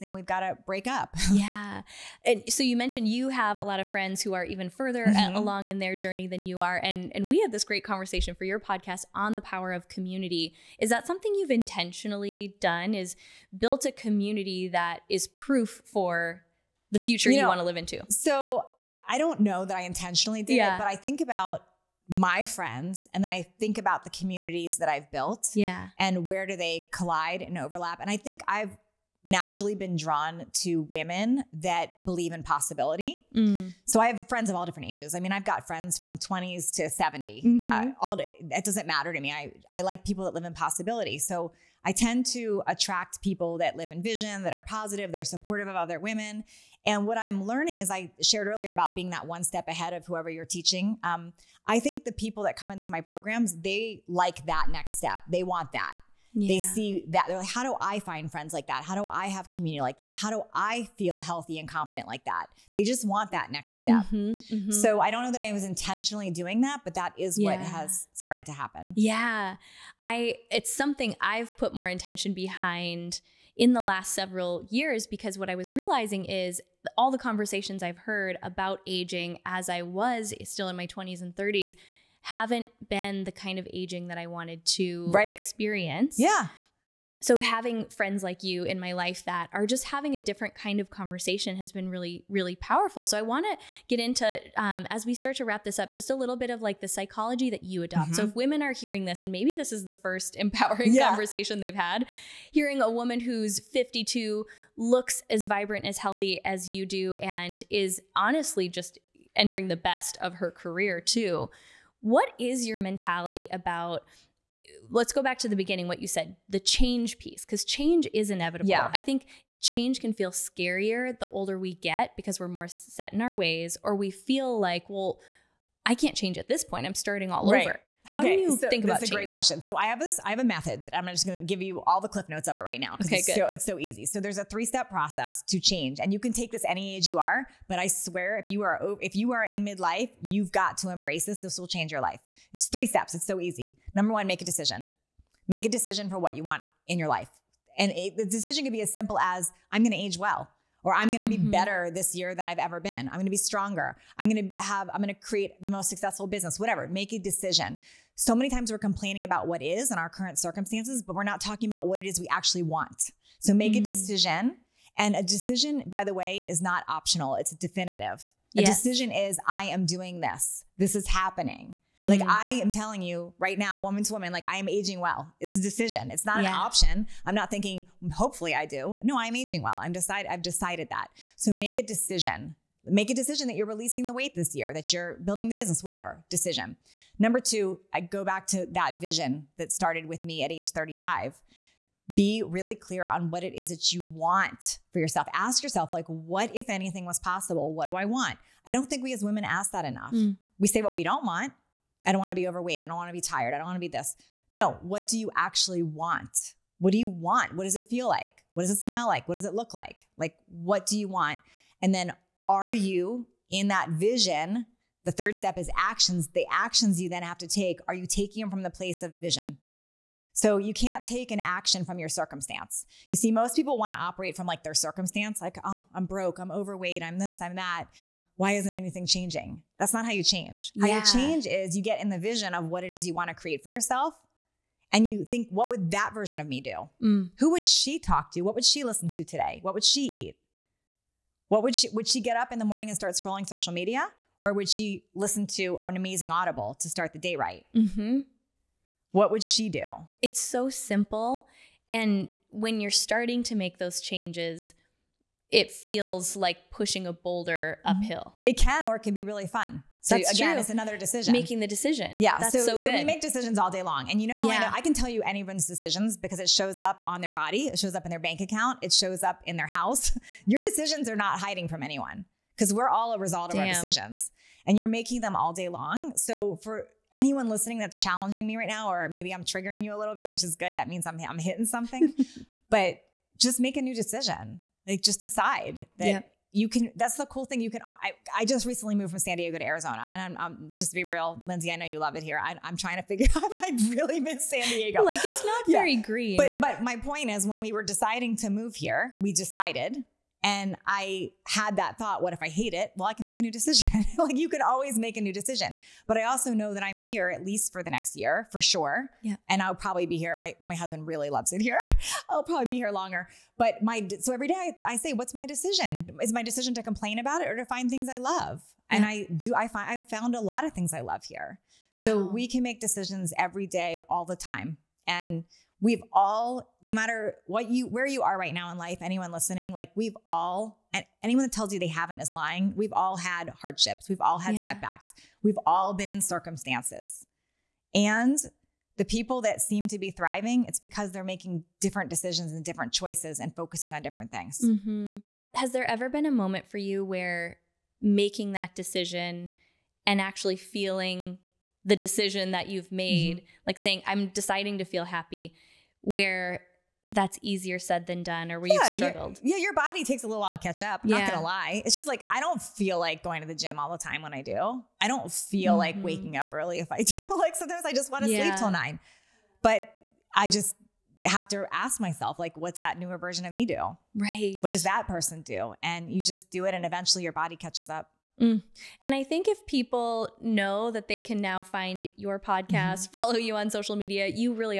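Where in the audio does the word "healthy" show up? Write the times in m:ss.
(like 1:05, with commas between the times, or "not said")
1:01, 1:45.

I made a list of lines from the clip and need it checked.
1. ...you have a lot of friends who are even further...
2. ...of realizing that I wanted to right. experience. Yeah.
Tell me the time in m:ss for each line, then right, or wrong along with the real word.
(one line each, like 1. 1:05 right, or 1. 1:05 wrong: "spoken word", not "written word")
1. 0:03 right
2. 1:23 wrong: "aging", not "realizing".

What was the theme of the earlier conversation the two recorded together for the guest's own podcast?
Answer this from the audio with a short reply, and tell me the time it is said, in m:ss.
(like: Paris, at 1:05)
The power of community, at 0:09.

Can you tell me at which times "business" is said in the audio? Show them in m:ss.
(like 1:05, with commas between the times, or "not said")
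2:36, 3:05.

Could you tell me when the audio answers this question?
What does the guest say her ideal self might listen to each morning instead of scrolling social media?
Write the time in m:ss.
4:06.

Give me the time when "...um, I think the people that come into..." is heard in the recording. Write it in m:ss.
0:51.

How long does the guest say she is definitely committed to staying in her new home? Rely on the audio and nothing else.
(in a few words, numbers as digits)
The next year.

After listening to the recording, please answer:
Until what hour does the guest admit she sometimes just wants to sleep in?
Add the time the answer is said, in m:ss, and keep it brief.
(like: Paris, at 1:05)
9, at 6:08.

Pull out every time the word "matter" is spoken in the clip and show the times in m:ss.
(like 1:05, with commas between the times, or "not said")
0:38, 5:26.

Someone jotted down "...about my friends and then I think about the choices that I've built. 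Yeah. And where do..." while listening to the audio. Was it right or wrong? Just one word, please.
wrong.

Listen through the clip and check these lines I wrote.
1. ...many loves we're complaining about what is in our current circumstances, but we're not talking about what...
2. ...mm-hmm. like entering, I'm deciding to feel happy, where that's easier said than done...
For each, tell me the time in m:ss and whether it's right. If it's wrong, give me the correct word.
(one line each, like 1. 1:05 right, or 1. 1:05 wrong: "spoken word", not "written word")
1. 2:38 wrong: "times", not "loves"
2. 5:53 wrong: "saying", not "entering".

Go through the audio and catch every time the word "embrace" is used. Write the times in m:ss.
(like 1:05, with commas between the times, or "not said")
2:20.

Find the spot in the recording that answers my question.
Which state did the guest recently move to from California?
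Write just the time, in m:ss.
4:49.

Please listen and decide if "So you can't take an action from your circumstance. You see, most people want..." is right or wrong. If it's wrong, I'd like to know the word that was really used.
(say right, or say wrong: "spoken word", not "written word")
right.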